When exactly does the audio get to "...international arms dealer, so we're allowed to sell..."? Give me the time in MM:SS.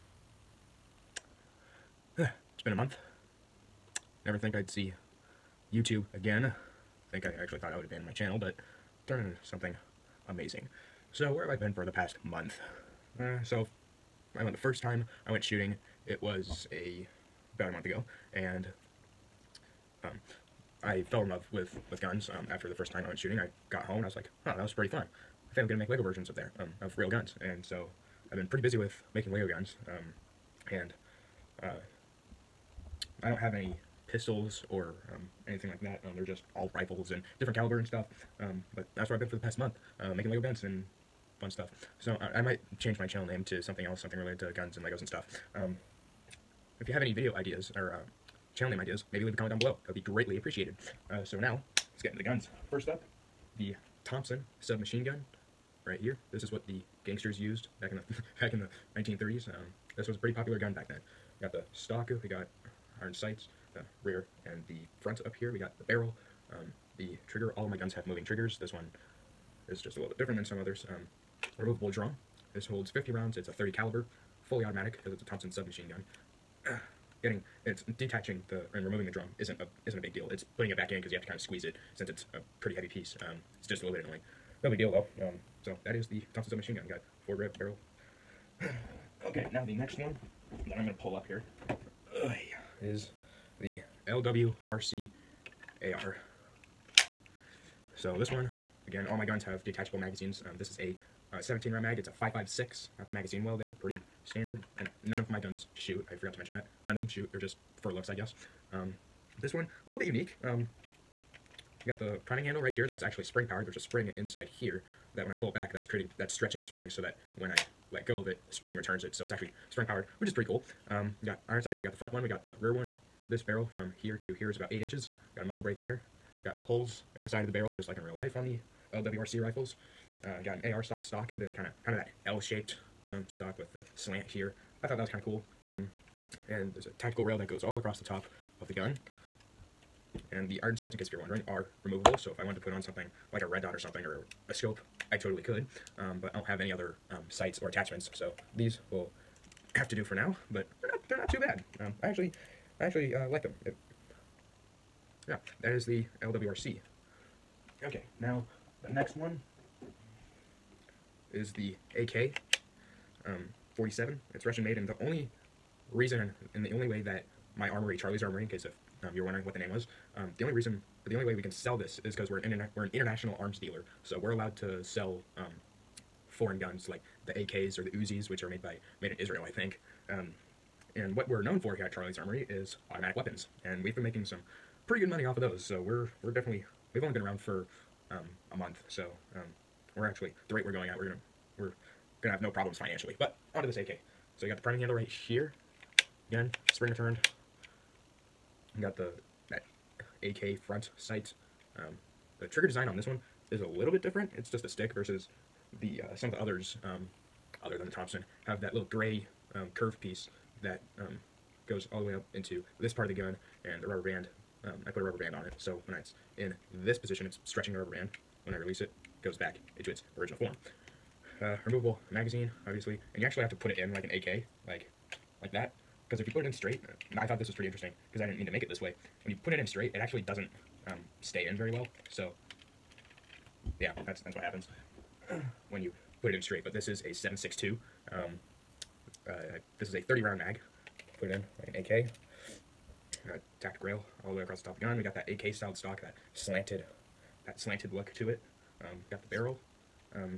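02:52.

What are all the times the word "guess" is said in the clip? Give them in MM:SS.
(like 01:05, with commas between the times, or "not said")
01:48.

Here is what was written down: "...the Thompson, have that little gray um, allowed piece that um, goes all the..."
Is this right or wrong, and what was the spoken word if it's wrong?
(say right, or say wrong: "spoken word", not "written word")
wrong: "curved", not "allowed".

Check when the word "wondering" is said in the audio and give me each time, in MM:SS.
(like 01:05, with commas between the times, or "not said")
02:21, 02:49.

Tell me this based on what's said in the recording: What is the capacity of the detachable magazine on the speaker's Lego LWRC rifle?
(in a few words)
17 rounds.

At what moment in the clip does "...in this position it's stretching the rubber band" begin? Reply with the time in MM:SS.
03:36.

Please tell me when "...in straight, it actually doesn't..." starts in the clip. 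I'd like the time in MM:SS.
03:49.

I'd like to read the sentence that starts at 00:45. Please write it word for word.
Um, if you have any video ideas or uh, channel name ideas, maybe leave a comment down below.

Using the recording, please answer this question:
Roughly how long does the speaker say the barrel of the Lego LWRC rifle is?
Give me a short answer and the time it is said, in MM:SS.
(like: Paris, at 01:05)
8 inches, at 02:04.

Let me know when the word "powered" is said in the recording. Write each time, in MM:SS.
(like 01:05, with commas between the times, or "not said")
01:53, 01:59.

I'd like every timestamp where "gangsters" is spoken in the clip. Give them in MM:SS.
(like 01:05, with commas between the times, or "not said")
00:57.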